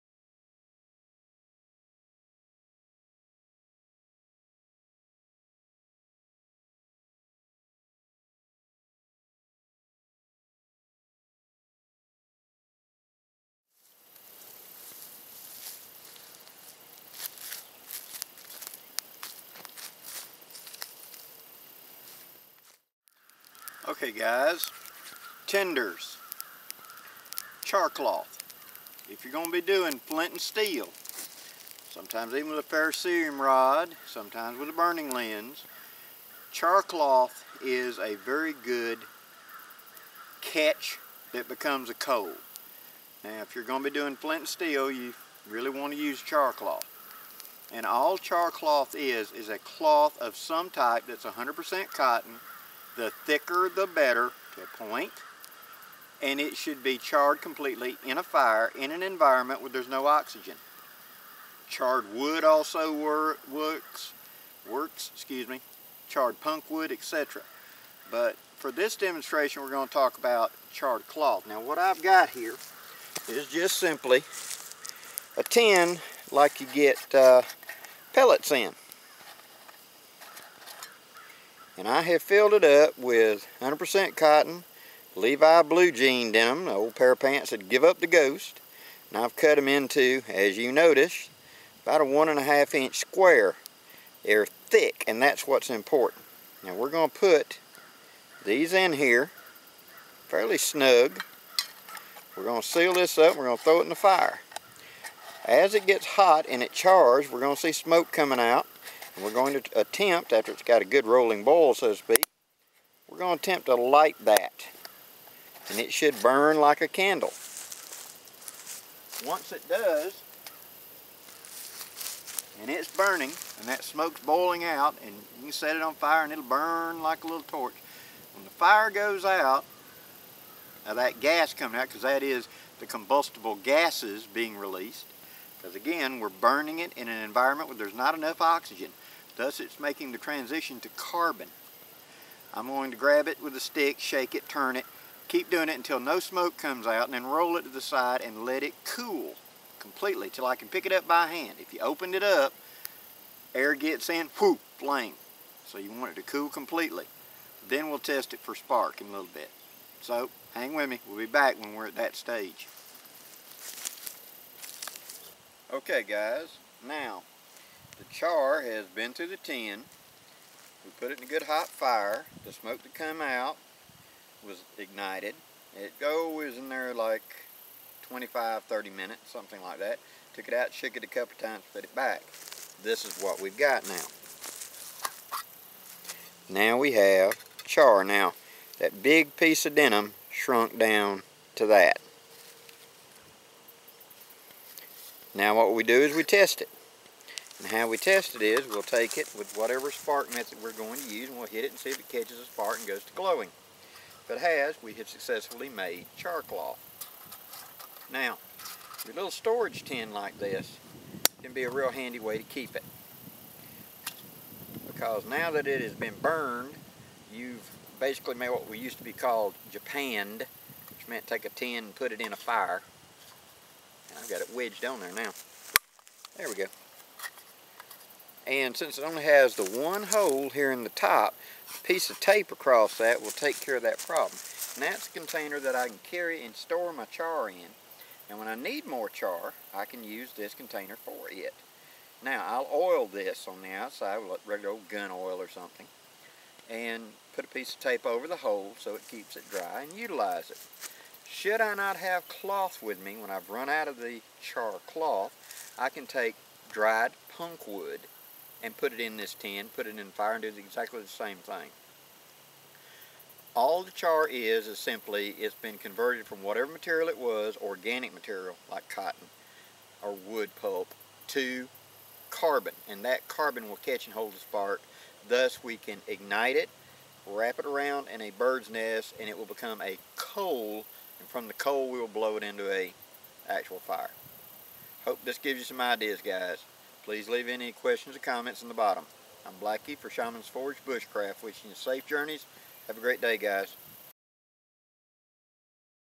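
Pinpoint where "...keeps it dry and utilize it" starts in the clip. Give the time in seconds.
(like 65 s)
249 s.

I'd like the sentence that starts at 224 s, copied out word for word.
And I've got it wedged on there now.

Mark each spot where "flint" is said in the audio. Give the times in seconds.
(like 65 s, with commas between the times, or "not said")
30 s, 44 s.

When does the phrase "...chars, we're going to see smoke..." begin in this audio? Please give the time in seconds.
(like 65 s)
106 s.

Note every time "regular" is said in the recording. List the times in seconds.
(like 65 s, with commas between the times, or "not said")
244 s.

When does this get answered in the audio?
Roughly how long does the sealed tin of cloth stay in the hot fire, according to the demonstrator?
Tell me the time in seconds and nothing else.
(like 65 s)
178 s.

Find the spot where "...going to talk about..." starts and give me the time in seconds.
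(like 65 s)
69 s.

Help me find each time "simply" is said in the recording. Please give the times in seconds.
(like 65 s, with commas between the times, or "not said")
73 s, 264 s.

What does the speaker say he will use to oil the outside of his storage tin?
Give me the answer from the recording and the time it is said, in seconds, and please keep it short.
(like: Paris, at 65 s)
gun oil, at 244 s.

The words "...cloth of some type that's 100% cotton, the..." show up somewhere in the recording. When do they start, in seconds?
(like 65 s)
49 s.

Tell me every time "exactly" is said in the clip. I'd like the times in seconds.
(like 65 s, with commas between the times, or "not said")
260 s.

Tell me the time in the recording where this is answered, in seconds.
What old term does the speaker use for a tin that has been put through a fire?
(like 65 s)
219 s.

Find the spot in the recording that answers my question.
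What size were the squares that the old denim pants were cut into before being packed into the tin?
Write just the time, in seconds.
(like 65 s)
92 s.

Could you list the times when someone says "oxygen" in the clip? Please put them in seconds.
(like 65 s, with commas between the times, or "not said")
60 s, 138 s.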